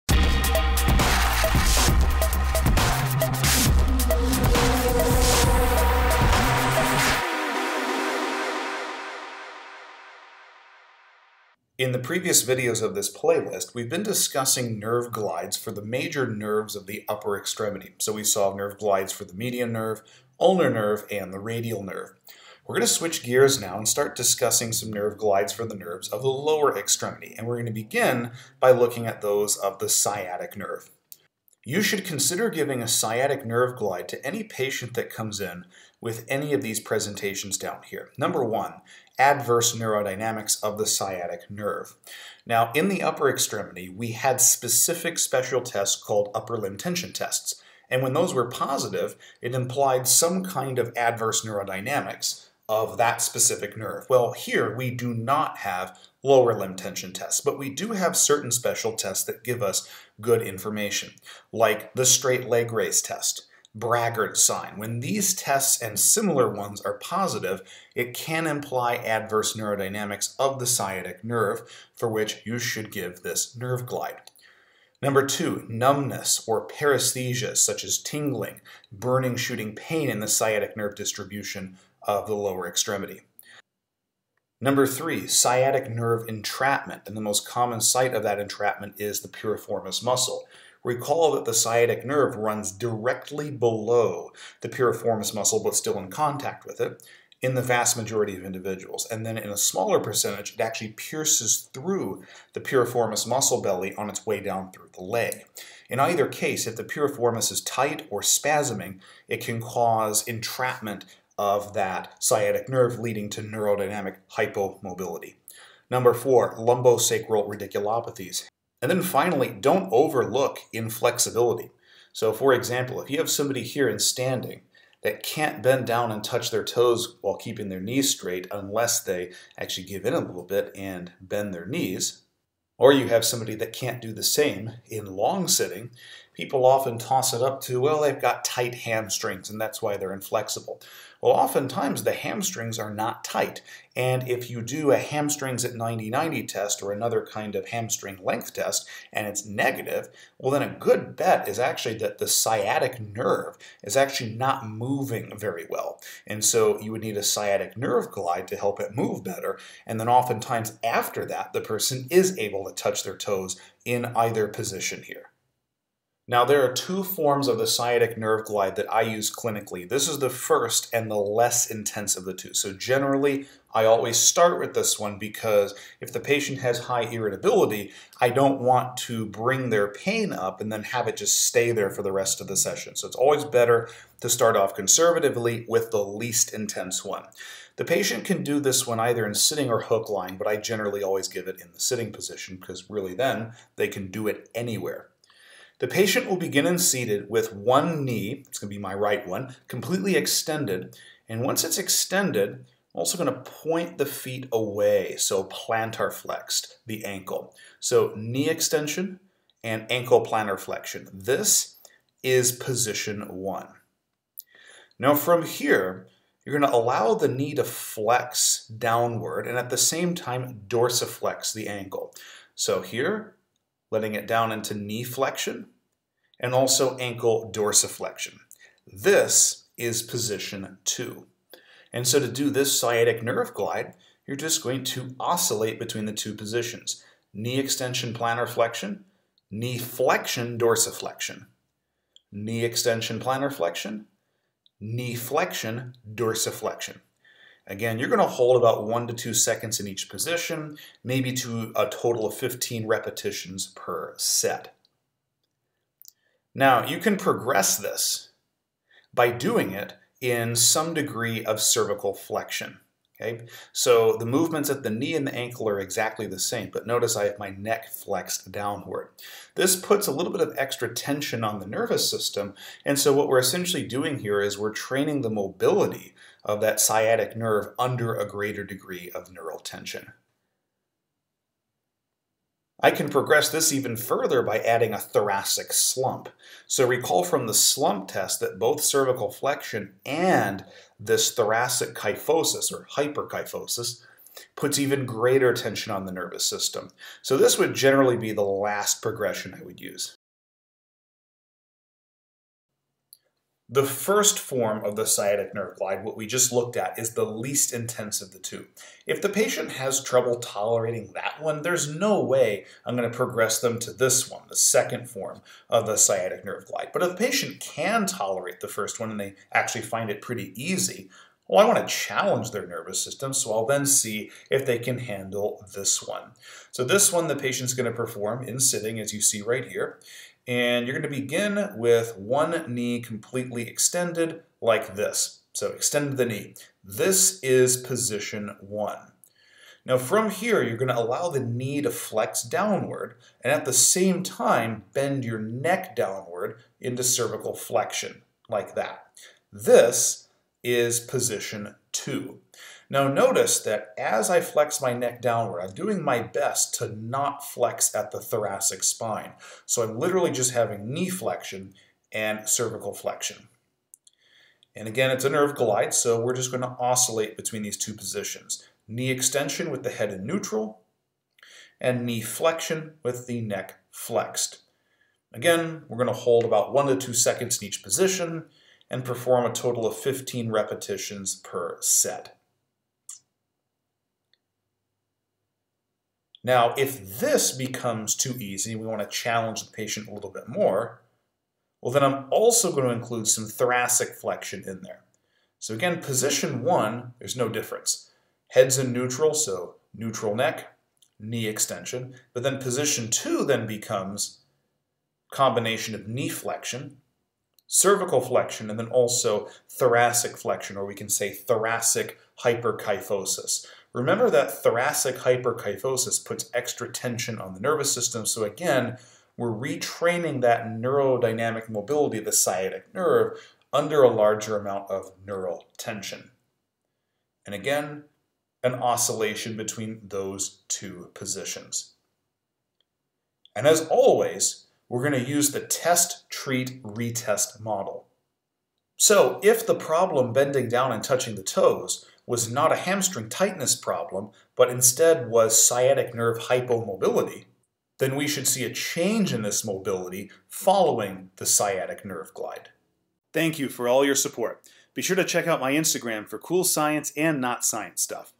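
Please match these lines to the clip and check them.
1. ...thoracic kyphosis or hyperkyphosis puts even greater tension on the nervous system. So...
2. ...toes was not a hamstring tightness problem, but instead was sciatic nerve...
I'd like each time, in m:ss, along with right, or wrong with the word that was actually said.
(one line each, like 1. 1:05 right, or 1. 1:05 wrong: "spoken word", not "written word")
1. 4:51 right
2. 7:21 right.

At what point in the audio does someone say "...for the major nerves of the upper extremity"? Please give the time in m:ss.
0:15.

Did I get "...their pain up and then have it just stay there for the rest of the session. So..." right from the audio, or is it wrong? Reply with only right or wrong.
right.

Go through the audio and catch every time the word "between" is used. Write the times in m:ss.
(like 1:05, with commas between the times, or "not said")
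3:55, 6:07, 7:09.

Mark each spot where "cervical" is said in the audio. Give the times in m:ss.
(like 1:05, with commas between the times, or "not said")
4:21, 4:48, 5:47, 6:02, 6:47.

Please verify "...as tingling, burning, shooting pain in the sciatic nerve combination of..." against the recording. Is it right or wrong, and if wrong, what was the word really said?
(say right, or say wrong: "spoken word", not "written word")
wrong: "distribution", not "combination".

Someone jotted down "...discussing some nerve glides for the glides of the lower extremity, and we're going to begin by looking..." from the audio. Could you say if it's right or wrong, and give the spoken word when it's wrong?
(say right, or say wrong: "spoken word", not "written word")
wrong: "nerves", not "glides".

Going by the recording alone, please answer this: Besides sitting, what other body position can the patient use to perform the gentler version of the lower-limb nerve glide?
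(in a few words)
hook lying.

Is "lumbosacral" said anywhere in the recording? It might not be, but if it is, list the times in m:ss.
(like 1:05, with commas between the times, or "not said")
1:56.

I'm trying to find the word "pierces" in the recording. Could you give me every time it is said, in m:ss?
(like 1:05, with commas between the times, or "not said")
1:40.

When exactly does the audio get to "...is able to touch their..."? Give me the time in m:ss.
2:42.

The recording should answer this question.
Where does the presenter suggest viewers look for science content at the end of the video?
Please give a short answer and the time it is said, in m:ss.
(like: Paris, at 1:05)
Instagram, at 7:35.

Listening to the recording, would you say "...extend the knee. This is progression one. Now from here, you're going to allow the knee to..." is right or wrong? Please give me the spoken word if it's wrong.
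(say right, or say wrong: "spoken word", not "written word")
wrong: "position", not "progression".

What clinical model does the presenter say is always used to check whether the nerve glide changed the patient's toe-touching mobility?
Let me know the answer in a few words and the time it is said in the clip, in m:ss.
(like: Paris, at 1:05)
test, treat, retest, at 7:15.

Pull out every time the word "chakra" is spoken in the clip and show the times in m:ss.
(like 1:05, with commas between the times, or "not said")
not said.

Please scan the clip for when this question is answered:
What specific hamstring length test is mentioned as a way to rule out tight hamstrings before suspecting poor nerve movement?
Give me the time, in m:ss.
2:24.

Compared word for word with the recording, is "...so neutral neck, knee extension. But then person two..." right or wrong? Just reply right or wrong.
wrong.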